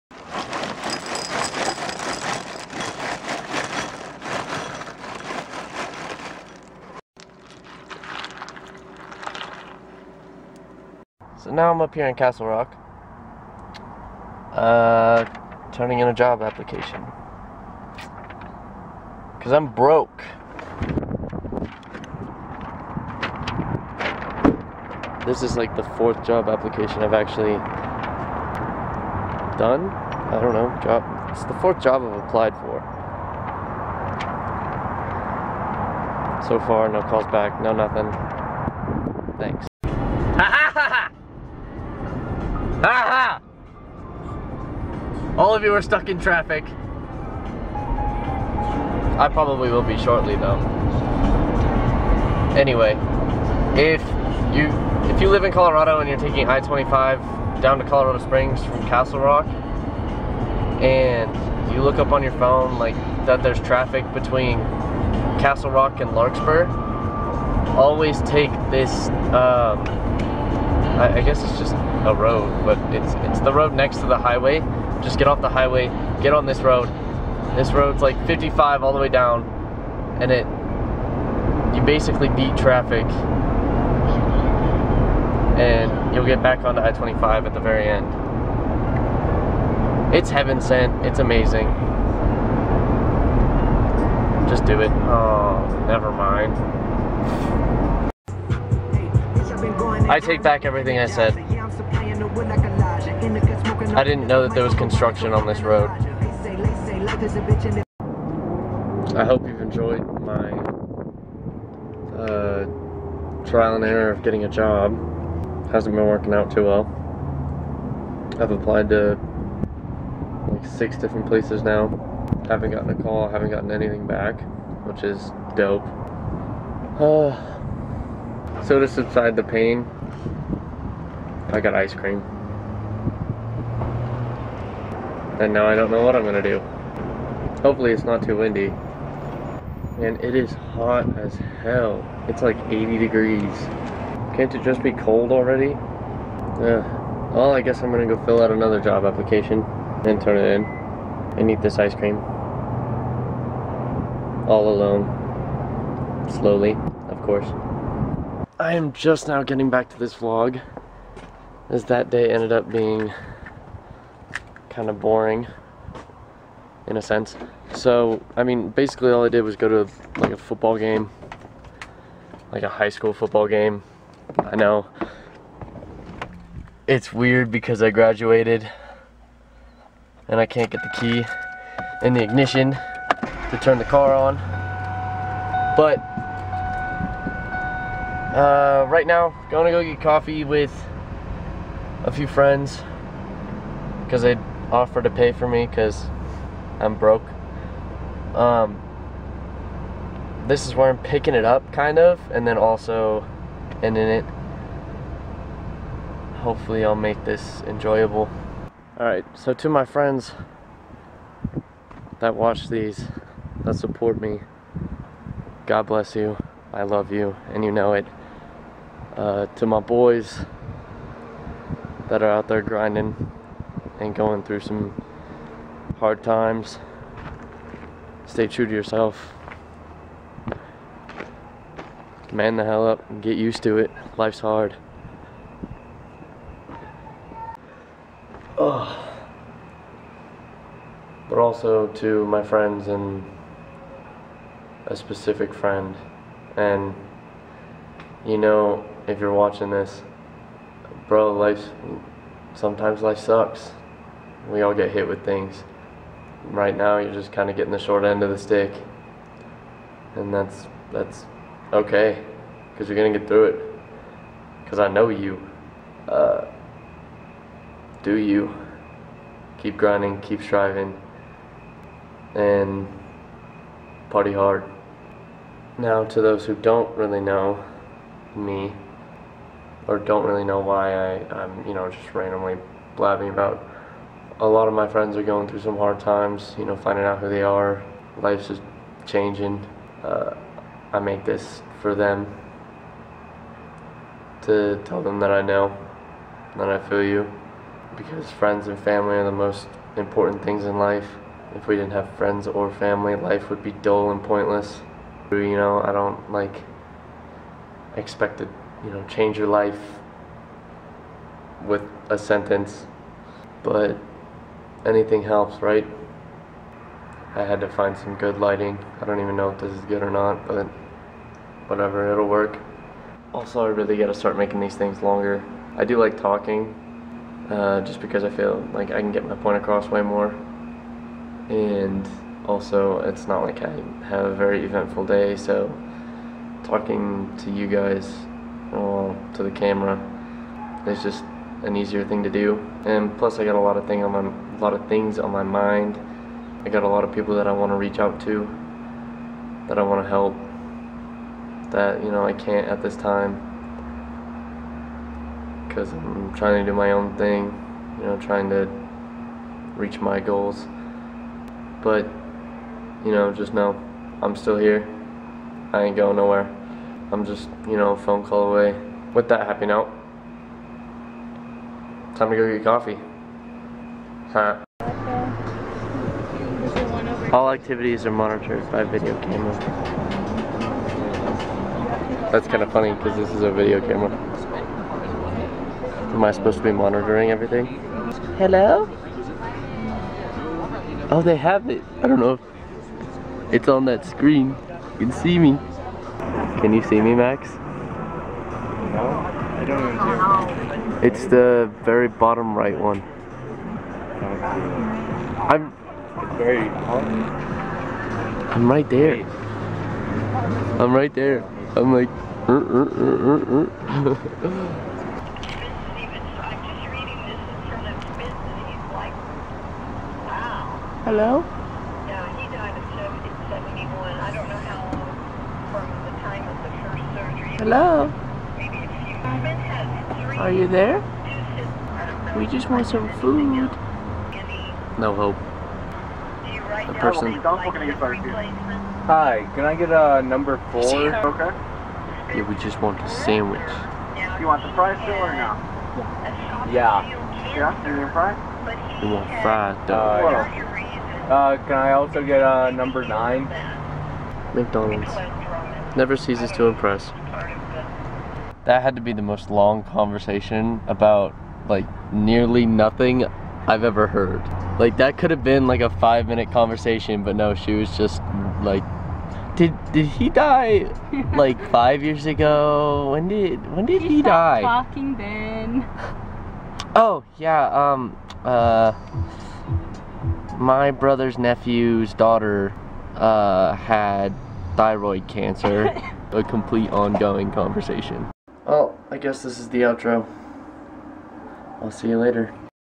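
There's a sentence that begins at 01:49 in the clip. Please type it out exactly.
I hope you've enjoyed my uh, trial and error of getting a job.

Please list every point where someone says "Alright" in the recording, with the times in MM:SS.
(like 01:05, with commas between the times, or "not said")
03:28.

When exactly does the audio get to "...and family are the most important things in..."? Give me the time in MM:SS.
04:58.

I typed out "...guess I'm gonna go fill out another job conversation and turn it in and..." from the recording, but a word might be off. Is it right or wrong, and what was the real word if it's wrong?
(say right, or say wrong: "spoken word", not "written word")
wrong: "application", not "conversation".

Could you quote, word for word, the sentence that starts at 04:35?
Now, to those who don't really know me, or don't really know why I, I'm, you know, just randomly blabbing about.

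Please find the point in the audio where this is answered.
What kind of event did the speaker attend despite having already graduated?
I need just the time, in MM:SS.
02:52.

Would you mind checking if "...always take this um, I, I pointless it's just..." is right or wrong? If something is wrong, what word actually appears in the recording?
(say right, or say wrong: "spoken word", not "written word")
wrong: "guess", not "pointless".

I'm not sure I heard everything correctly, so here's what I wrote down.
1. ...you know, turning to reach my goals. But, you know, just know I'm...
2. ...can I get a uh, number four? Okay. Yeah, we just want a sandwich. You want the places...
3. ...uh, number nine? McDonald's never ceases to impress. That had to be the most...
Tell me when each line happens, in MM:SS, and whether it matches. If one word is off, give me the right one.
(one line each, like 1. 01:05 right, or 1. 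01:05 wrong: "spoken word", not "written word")
1. 05:57 wrong: "trying", not "turning"
2. 07:19 wrong: "fries", not "places"
3. 07:32 right.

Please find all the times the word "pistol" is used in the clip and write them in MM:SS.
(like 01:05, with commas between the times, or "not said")
not said.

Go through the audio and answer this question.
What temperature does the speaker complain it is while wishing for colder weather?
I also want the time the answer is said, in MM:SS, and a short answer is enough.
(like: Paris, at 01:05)
80 degrees, at 02:22.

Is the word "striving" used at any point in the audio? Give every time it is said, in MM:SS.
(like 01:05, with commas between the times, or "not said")
04:30.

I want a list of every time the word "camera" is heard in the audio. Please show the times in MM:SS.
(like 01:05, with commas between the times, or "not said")
05:39, 06:19, 06:23.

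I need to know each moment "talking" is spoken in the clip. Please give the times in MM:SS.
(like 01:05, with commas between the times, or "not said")
05:26, 05:36, 07:54.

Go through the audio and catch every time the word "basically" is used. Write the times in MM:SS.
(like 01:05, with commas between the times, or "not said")
01:21, 02:48.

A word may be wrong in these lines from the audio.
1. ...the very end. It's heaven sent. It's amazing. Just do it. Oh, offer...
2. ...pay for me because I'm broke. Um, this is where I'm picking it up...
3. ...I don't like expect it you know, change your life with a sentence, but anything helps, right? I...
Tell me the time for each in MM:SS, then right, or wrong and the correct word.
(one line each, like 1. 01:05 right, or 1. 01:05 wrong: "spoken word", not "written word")
1. 01:27 wrong: "never", not "offer"
2. 03:15 right
3. 05:05 right.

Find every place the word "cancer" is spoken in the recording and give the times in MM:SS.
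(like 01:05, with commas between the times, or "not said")
08:05.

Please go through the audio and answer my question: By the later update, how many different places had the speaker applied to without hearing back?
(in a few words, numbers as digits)
6.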